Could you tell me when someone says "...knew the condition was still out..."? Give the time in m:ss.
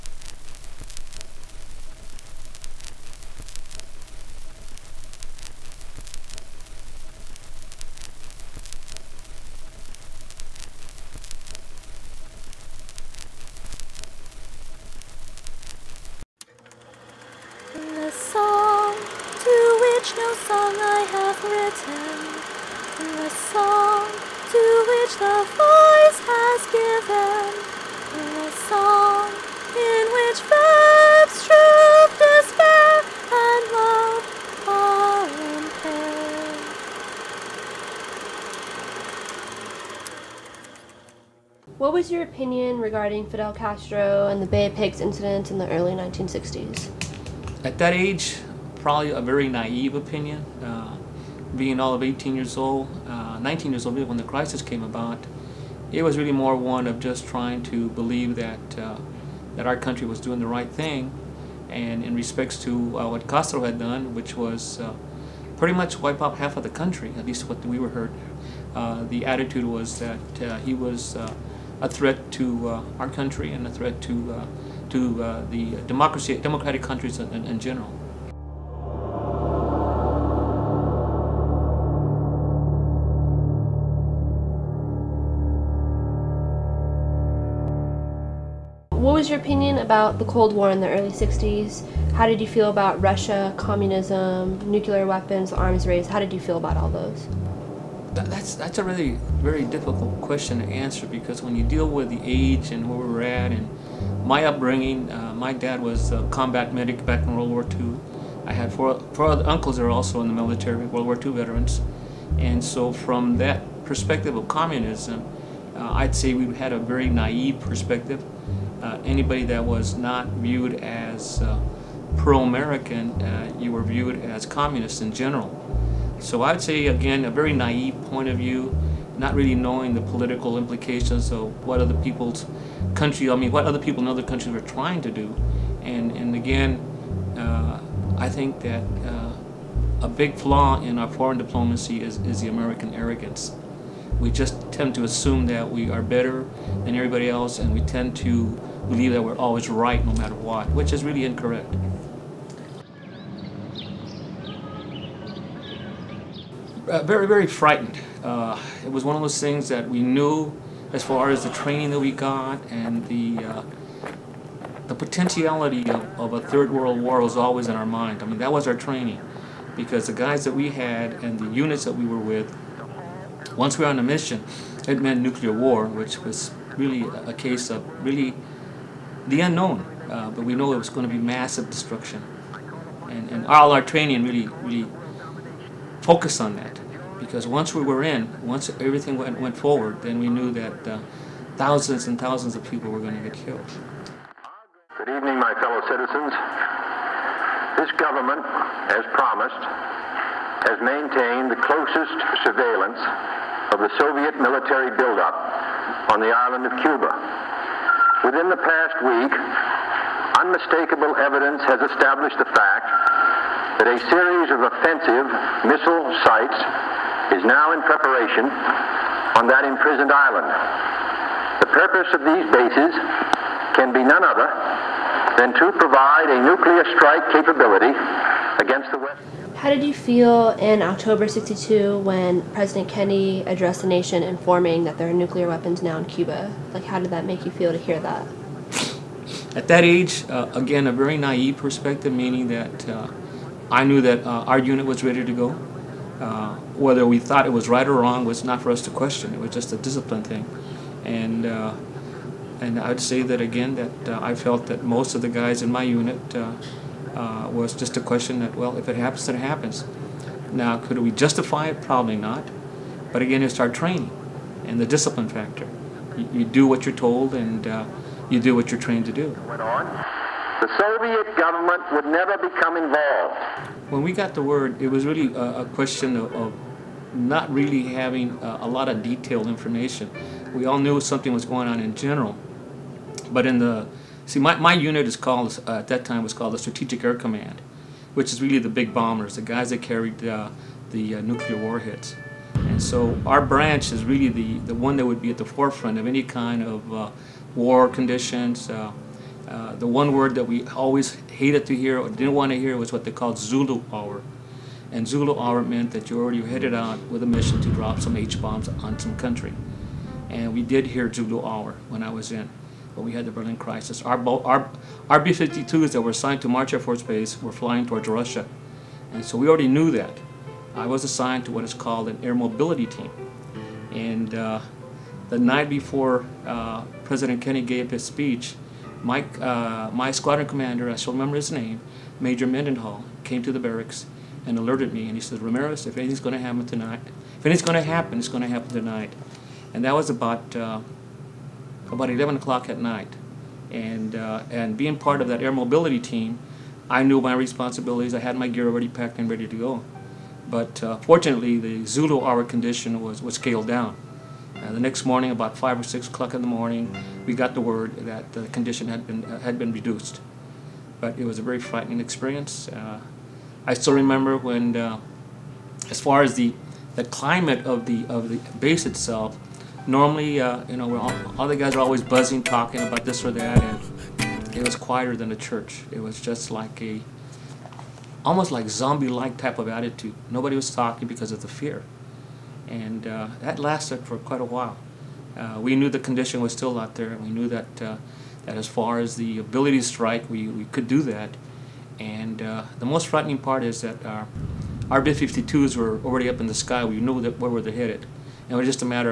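6:25.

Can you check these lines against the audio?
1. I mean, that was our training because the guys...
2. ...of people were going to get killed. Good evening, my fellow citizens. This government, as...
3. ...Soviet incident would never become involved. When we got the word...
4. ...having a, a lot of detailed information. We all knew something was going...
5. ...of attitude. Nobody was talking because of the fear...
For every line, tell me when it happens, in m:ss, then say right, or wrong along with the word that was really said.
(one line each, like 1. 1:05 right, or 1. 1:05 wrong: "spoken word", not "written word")
1. 2:48 right
2. 3:12 right
3. 4:30 wrong: "government", not "incident"
4. 4:37 right
5. 6:19 right.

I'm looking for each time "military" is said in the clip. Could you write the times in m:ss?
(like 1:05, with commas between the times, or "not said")
1:50, 3:24.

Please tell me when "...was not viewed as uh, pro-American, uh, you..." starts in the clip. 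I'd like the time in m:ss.
1:59.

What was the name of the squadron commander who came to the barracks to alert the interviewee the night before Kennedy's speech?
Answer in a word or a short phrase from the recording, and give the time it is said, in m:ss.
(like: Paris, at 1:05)
Major Mendenhall, at 5:32.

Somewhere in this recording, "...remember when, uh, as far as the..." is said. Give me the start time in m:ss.
6:03.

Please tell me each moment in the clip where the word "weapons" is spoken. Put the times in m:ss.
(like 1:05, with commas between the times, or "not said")
1:35, 3:55.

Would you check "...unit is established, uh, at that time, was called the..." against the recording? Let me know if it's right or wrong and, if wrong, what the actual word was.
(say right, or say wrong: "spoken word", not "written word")
wrong: "called", not "established".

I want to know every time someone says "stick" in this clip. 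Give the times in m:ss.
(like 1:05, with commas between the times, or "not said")
not said.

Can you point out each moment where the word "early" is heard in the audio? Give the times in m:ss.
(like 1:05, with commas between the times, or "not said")
0:45, 1:30.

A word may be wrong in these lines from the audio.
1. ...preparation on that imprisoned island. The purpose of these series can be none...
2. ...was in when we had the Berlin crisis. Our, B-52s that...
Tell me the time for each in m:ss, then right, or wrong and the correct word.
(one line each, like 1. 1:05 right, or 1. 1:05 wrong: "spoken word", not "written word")
1. 3:37 wrong: "bases", not "series"
2. 5:12 right.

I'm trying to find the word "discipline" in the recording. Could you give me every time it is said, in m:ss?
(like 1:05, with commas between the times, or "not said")
4:09, 4:24.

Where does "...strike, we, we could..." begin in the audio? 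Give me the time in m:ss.
6:29.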